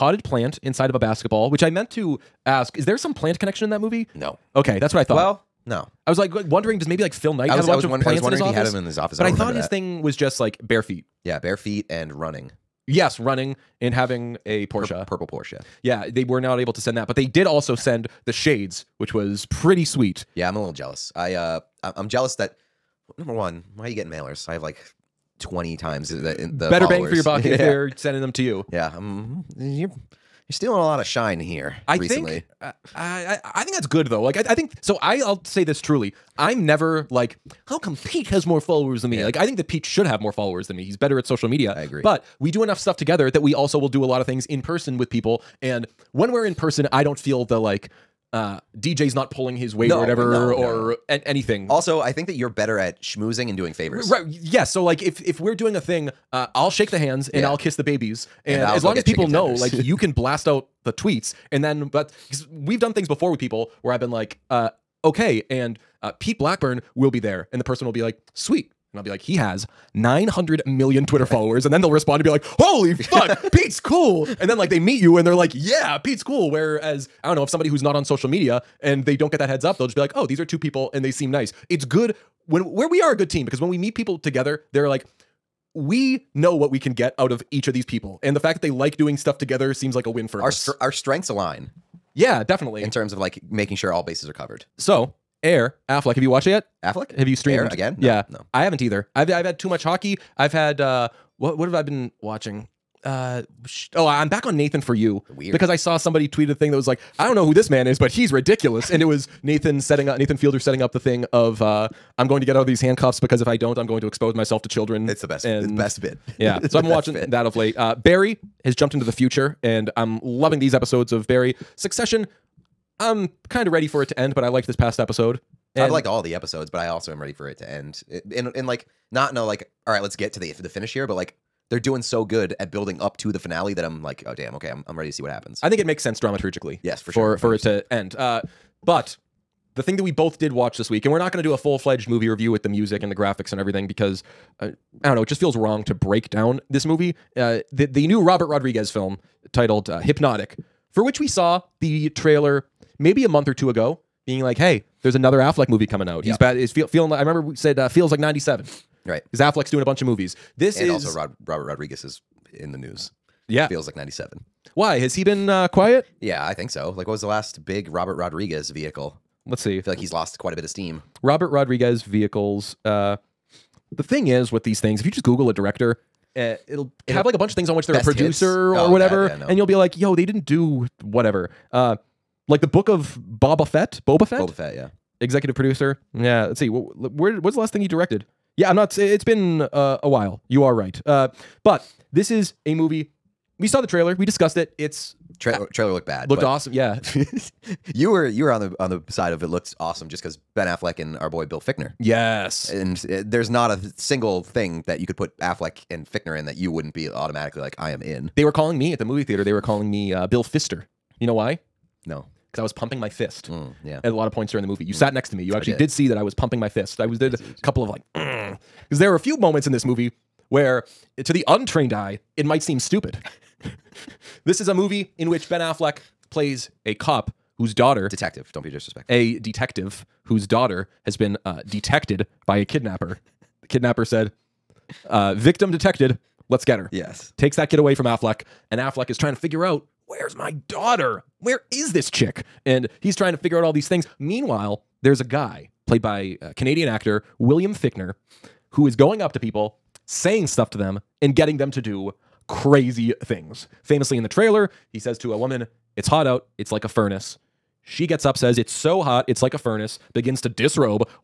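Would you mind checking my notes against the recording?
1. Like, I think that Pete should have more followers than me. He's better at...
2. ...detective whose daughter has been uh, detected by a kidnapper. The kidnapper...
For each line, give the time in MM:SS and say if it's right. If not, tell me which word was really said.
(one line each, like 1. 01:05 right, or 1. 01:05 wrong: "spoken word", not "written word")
1. 00:39 right
2. 03:49 right.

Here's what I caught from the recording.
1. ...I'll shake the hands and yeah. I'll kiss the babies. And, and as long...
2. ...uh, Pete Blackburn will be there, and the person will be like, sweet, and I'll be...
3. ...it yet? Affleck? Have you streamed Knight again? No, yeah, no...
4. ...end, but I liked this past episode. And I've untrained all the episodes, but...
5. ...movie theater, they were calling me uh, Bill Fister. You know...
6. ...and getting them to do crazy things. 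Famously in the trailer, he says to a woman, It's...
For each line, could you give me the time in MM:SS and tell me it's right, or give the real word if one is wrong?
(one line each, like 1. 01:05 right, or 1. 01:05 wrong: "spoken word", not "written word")
1. 00:56 right
2. 01:06 right
3. 01:36 wrong: "Air", not "Knight"
4. 02:04 wrong: "liked", not "untrained"
5. 03:29 right
6. 04:11 right.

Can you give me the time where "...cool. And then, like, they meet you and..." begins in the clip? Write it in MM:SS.
01:13.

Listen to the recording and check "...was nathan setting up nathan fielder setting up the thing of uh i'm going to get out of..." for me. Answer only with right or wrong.
right.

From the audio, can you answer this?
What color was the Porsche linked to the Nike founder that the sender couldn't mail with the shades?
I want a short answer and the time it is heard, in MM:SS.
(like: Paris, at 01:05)
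Purple, at 00:15.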